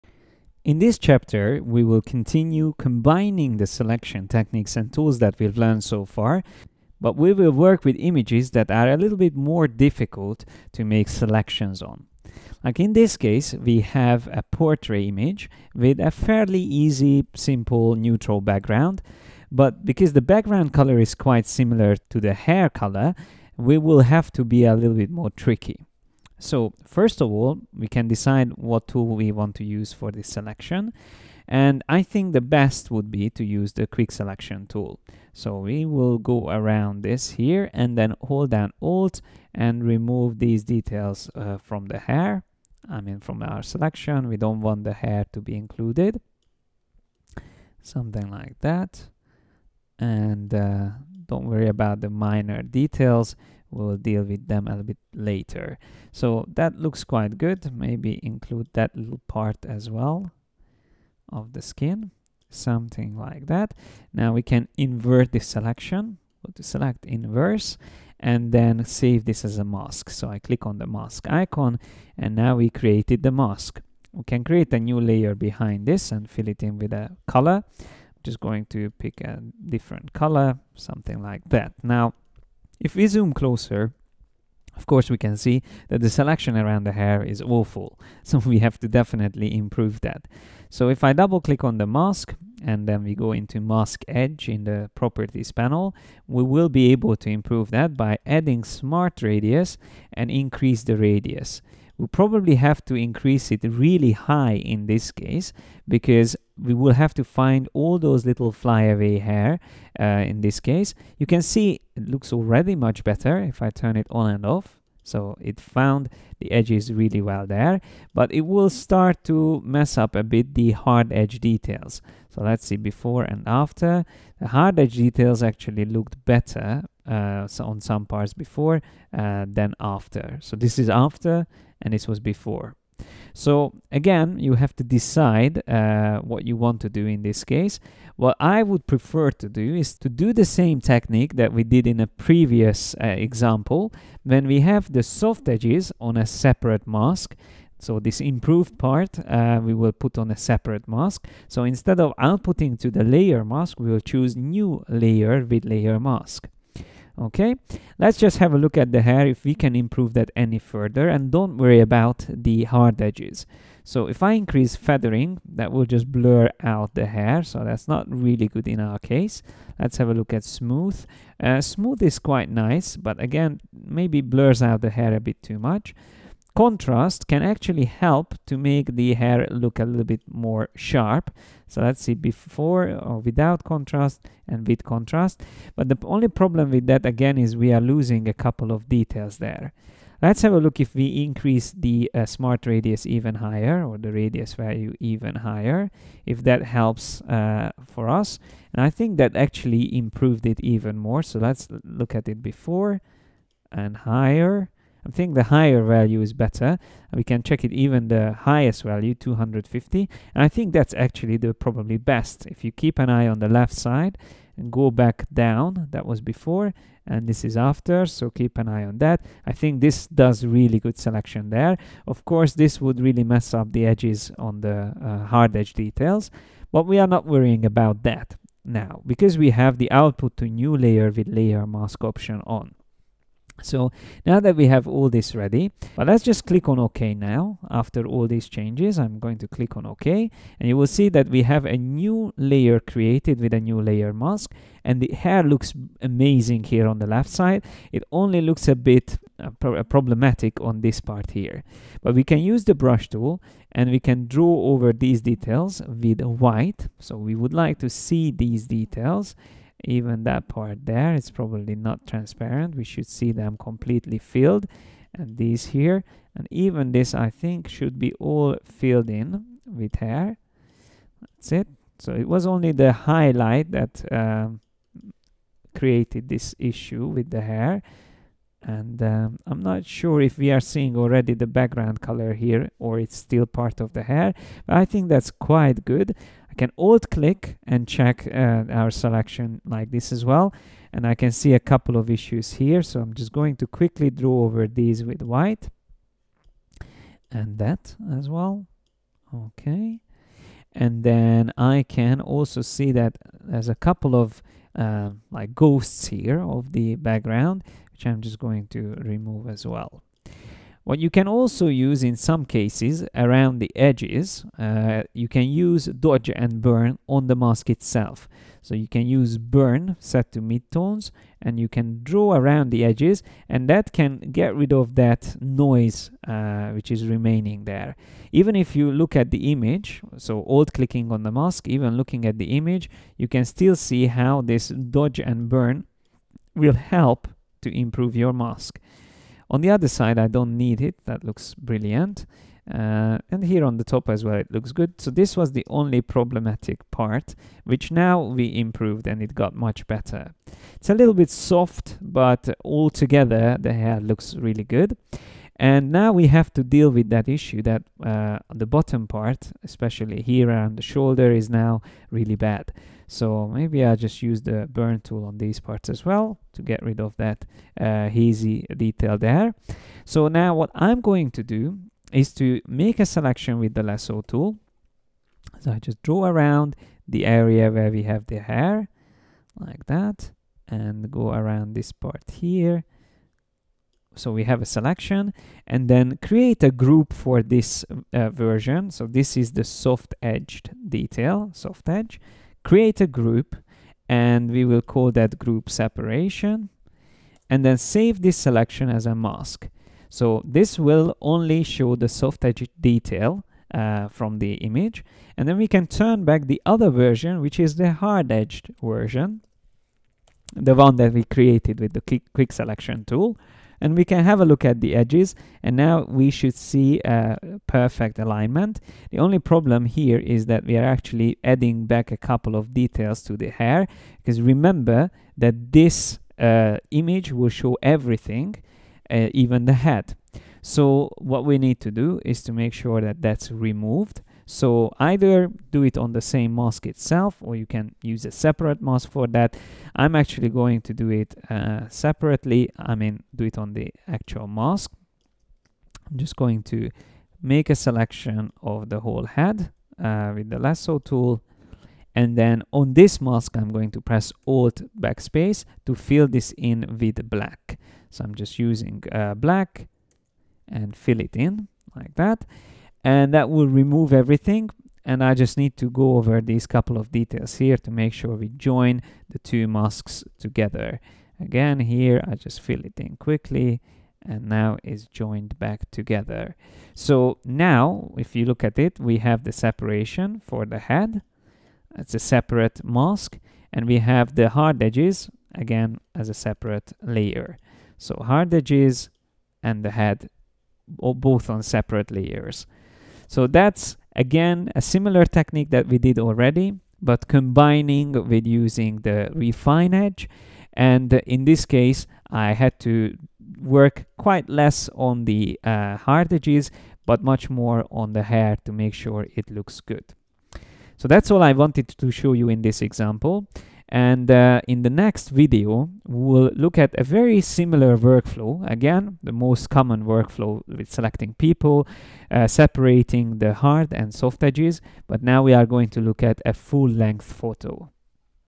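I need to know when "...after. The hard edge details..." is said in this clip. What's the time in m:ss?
2:03.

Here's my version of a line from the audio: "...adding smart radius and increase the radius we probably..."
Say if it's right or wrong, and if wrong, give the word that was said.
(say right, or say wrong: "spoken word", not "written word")
right.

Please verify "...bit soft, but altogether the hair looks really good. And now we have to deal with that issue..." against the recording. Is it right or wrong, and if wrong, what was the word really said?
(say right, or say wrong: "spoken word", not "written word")
right.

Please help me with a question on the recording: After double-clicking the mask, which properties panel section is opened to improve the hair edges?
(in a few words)
mask edge.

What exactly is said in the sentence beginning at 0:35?
So we will go around this here and then hold down Alt and remove these details uh, from the hair.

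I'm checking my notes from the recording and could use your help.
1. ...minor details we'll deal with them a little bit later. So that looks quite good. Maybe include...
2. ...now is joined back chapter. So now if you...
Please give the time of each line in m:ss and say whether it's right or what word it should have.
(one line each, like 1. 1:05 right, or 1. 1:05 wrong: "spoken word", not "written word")
1. 0:52 right
2. 7:54 wrong: "together", not "chapter".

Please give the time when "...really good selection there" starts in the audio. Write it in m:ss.
3:40.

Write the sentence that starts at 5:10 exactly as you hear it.
What you can also use in some cases around the edges, uh, you can use dodge and burn on the mask itself.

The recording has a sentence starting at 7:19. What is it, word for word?
I'm actually going to do it uh, separately.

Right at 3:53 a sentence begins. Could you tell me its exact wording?
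So now that we have all this ready, but let's just click on OK now.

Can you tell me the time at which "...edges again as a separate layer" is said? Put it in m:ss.
8:04.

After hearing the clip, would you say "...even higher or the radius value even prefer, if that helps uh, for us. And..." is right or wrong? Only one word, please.
wrong.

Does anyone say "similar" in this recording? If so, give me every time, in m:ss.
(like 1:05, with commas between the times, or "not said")
0:21, 8:14, 8:37.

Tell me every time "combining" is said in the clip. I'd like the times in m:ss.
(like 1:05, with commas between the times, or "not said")
0:02, 8:17.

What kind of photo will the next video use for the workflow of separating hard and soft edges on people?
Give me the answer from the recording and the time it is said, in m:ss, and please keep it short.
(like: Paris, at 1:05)
full length photo, at 8:46.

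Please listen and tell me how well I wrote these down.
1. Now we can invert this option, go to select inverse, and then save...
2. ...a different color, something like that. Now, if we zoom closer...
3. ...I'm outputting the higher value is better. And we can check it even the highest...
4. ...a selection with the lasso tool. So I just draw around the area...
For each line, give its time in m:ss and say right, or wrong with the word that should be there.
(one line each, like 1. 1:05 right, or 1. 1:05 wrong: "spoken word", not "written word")
1. 1:04 wrong: "selection", not "option"
2. 1:19 right
3. 3:25 wrong: "thinking", not "outputting"
4. 6:13 right.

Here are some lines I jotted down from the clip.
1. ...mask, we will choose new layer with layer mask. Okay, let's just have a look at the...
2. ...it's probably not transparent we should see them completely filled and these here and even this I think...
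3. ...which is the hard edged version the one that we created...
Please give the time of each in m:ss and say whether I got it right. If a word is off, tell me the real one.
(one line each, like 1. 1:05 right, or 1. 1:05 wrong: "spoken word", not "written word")
1. 2:33 right
2. 4:21 right
3. 6:47 right.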